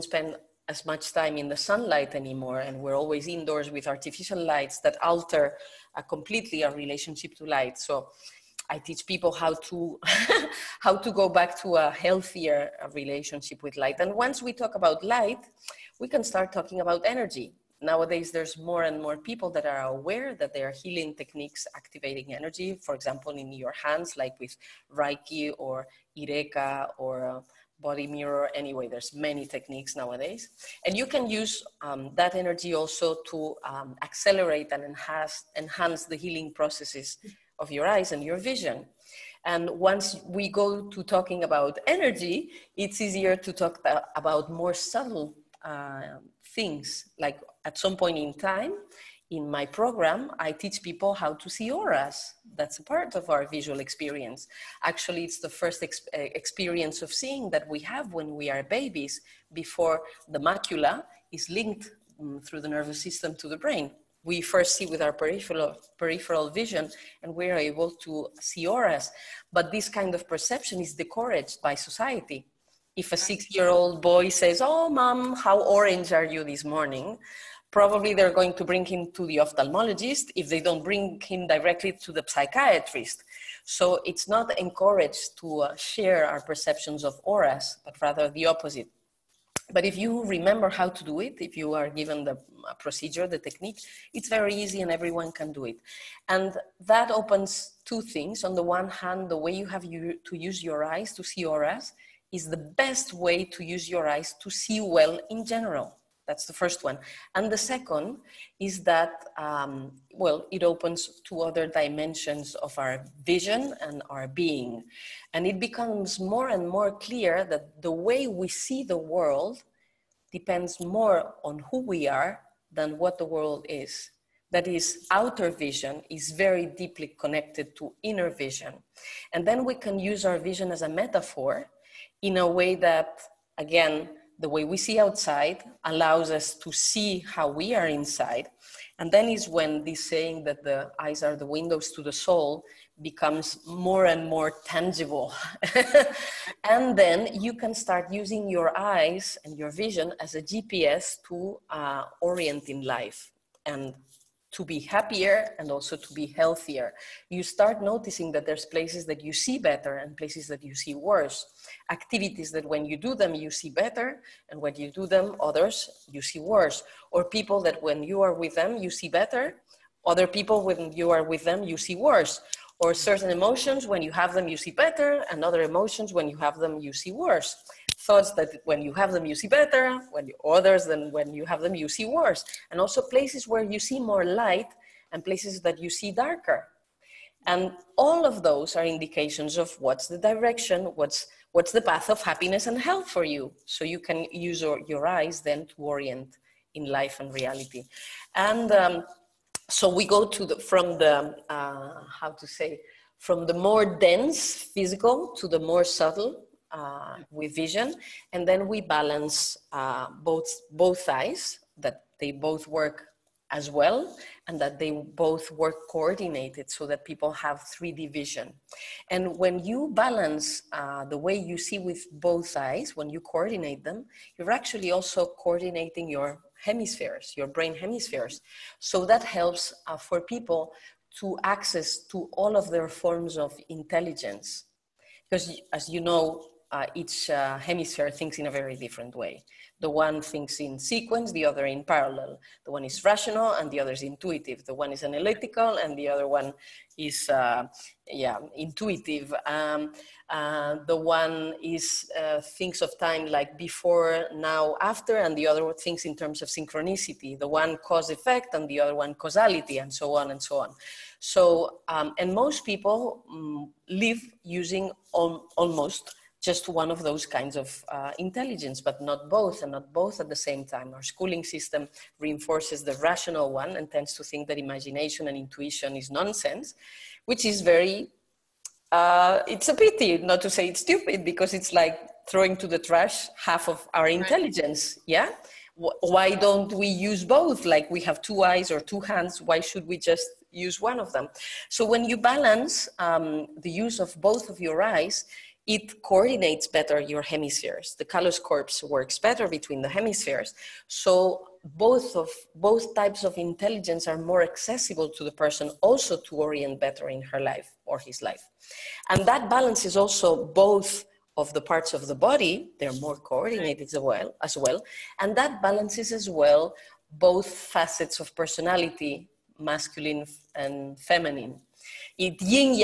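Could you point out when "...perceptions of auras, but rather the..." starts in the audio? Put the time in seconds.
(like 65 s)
86 s.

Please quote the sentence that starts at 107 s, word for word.
And the second is that, um, well, it opens to other dimensions of our vision and our being.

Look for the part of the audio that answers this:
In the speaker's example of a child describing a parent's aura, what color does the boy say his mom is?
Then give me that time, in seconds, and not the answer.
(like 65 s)
75 s.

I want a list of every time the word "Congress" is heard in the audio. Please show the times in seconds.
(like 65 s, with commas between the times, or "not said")
not said.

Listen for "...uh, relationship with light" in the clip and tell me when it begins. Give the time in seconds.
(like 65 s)
12 s.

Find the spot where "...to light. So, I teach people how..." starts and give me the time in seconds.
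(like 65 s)
7 s.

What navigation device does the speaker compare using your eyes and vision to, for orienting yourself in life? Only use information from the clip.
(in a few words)
GPS.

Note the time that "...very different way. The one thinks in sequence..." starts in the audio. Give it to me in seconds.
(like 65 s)
238 s.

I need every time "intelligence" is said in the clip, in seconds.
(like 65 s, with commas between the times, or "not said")
233 s, 268 s, 284 s, 303 s.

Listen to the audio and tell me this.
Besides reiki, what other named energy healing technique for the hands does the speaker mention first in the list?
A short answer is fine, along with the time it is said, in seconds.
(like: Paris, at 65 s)
ireka, at 26 s.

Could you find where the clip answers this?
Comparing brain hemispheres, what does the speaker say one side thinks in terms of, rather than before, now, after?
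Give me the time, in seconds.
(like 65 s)
256 s.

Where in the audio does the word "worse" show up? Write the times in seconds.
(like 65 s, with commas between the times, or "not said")
160 s, 166 s, 171 s, 177 s, 182 s.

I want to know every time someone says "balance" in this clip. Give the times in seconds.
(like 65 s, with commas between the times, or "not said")
208 s, 219 s, 292 s, 309 s, 315 s.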